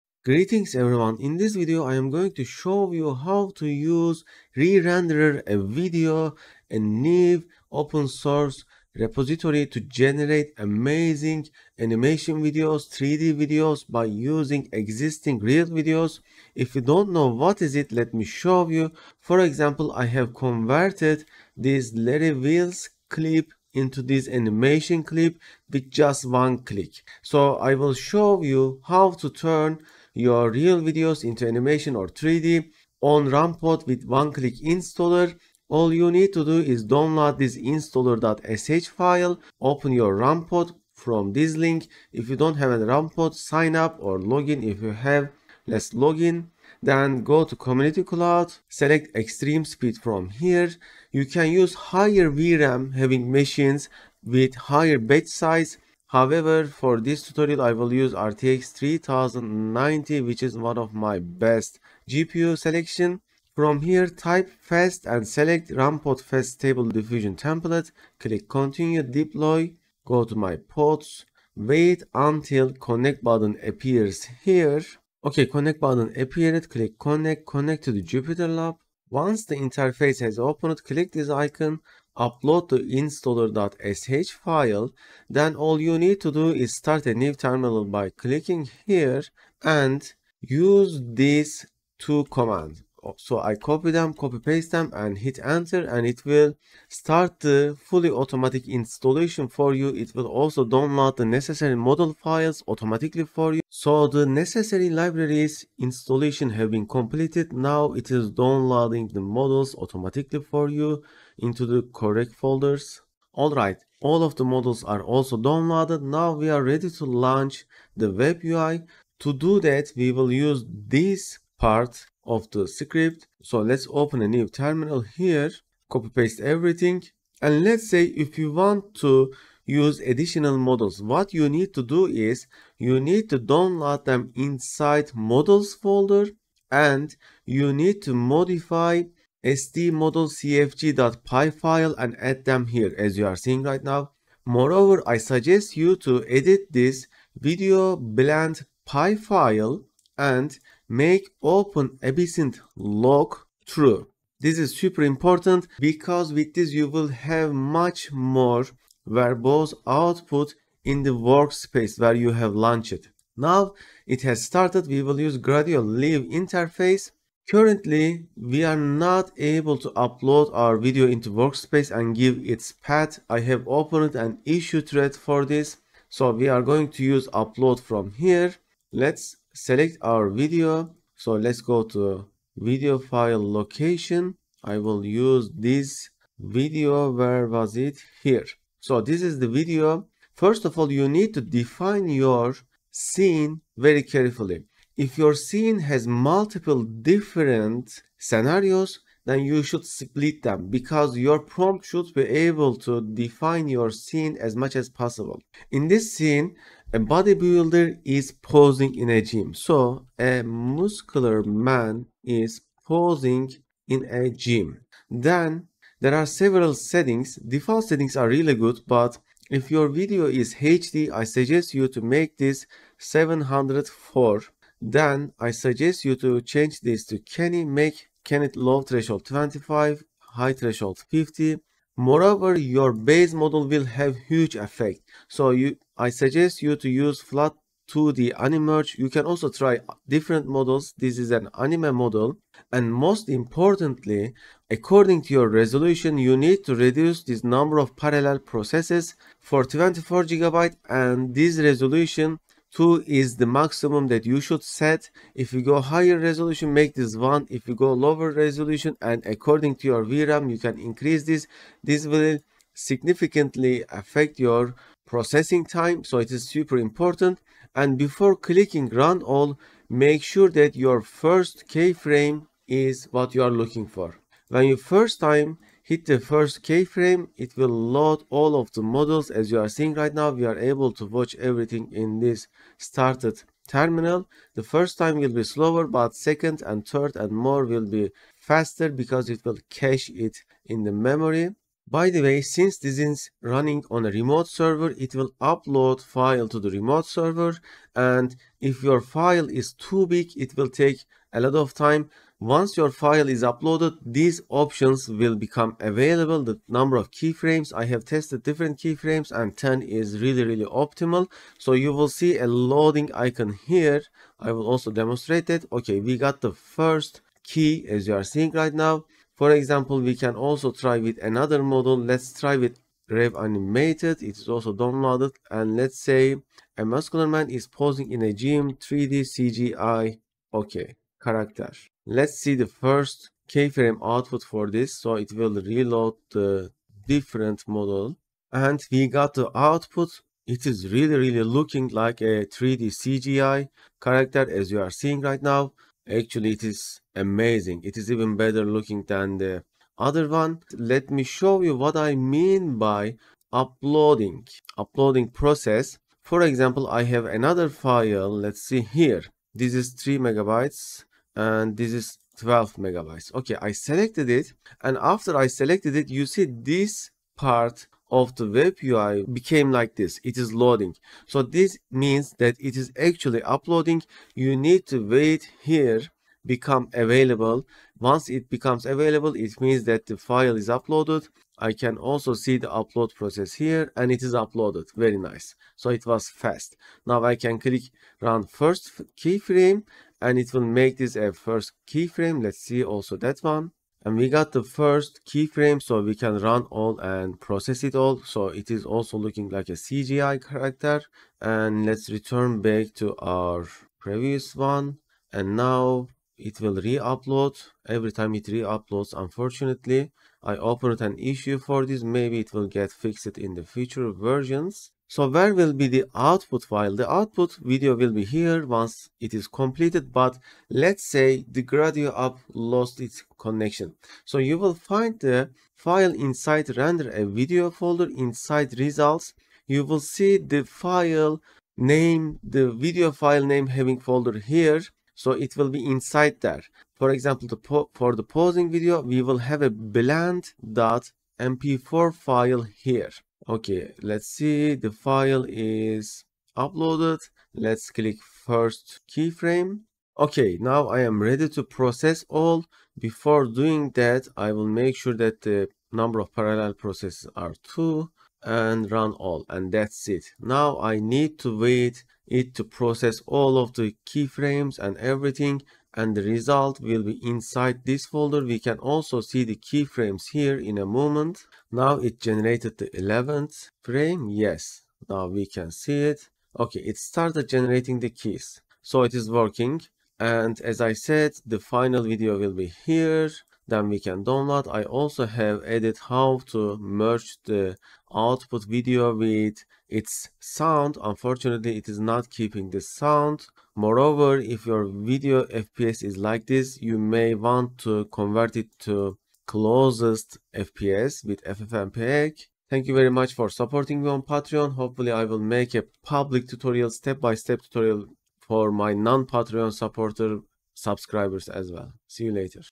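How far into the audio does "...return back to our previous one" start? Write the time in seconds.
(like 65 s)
402 s.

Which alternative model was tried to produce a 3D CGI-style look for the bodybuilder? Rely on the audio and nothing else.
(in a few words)
Rev Animated.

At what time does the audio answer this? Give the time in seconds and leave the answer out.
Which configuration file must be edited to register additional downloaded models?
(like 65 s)
139 s.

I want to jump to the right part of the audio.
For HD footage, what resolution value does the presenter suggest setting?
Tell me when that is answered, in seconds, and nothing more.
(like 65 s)
222 s.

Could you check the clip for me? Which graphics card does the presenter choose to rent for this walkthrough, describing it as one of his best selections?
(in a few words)
RTX 3090.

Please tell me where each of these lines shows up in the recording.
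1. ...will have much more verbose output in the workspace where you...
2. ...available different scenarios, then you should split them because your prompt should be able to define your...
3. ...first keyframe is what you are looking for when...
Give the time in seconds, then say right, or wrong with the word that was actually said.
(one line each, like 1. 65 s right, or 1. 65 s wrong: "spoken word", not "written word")
1. 156 s right
2. 196 s wrong: "multiple", not "available"
3. 271 s right.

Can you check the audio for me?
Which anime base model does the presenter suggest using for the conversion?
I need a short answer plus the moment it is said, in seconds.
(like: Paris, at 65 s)
flat 2D Animerge, at 237 s.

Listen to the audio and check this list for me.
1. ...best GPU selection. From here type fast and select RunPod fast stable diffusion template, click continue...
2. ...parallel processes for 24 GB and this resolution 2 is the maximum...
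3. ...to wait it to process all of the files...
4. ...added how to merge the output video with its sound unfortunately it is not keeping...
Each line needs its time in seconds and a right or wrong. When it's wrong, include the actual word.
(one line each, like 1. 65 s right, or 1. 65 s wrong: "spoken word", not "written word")
1. 61 s right
2. 247 s right
3. 461 s wrong: "keyframes", not "files"
4. 485 s right.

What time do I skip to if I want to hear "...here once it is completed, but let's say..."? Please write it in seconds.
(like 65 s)
418 s.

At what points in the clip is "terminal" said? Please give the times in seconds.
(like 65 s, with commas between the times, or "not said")
87 s, 124 s, 283 s.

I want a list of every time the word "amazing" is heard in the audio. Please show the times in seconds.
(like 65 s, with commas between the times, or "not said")
10 s, 347 s.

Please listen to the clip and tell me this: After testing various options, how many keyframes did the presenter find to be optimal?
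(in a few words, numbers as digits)
10.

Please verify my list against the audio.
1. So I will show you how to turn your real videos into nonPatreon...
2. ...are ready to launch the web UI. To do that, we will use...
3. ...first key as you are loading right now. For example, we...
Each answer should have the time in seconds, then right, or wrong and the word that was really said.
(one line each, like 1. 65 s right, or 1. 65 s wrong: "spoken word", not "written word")
1. 27 s wrong: "animation", not "nonPatreon"
2. 116 s right
3. 316 s wrong: "seeing", not "loading".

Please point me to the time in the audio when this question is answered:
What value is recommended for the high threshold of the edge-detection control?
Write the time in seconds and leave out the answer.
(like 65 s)
231 s.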